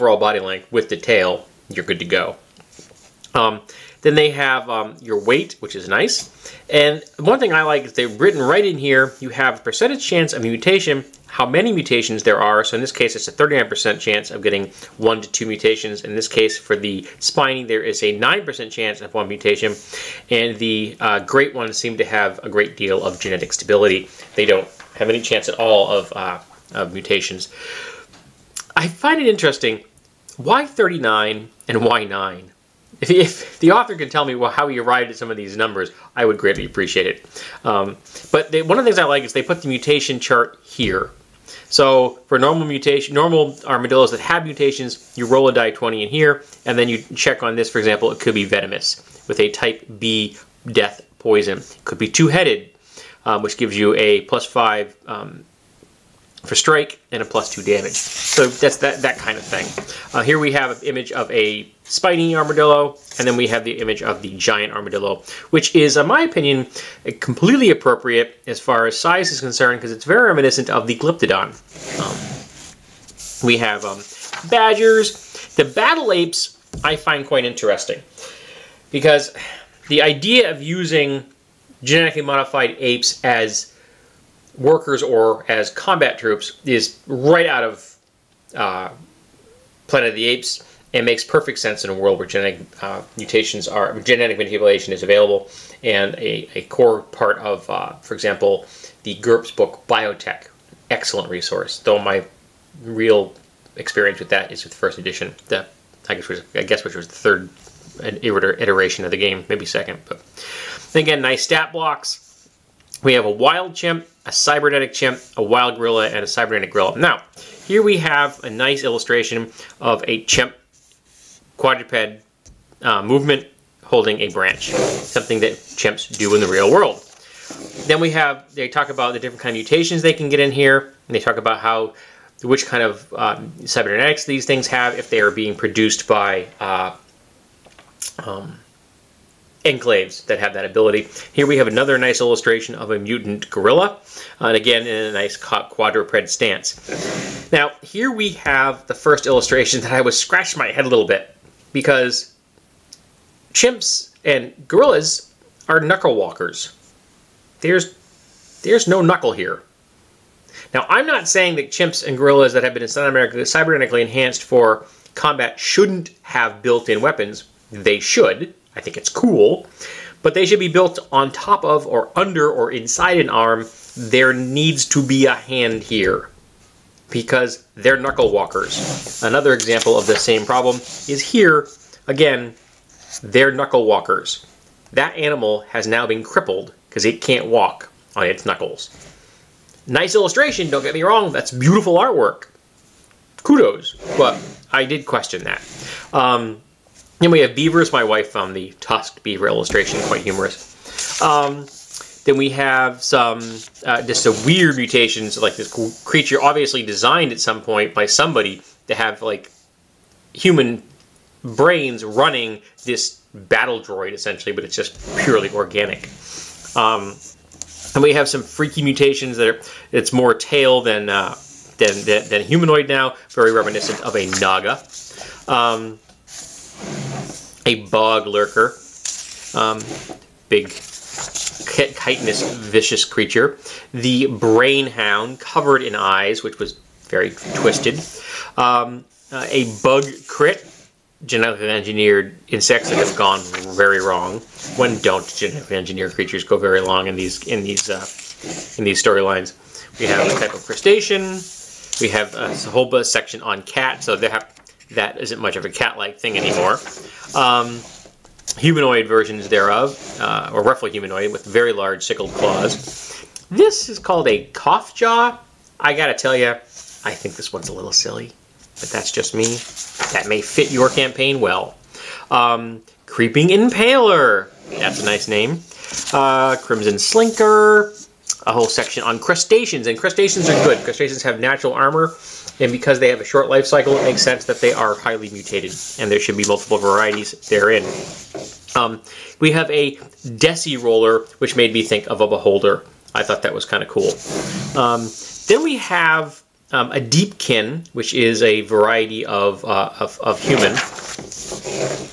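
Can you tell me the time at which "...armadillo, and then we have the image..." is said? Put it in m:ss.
1:02.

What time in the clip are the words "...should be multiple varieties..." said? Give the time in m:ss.
4:46.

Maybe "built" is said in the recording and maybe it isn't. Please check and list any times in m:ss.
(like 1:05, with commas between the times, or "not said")
2:46, 2:50.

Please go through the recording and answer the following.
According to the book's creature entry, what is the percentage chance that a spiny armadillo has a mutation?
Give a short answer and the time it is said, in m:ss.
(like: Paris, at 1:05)
9%, at 0:18.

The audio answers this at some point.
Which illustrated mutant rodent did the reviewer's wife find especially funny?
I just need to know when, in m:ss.
3:18.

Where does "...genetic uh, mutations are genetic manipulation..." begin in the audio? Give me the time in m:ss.
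1:32.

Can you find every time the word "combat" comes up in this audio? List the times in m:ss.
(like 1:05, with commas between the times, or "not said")
1:25, 2:45.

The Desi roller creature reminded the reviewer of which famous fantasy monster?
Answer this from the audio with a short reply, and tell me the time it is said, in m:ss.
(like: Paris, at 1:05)
Beholder, at 4:52.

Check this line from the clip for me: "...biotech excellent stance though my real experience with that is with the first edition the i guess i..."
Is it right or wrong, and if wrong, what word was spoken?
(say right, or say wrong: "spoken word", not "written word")
wrong: "resource", not "stance".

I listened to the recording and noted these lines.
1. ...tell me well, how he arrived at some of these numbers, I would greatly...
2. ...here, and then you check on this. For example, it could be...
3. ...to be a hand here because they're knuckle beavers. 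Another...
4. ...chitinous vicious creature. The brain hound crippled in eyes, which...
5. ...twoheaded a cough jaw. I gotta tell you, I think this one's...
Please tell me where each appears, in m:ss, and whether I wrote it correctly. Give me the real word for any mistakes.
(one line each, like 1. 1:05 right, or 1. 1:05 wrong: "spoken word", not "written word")
1. 0:34 right
2. 0:46 right
3. 2:54 wrong: "walkers", not "beavers"
4. 3:50 wrong: "covered", not "crippled"
5. 4:23 wrong: "called", not "twoheaded".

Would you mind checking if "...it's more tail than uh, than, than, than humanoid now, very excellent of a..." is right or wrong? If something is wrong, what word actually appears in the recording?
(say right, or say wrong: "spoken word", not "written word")
wrong: "reminiscent", not "excellent".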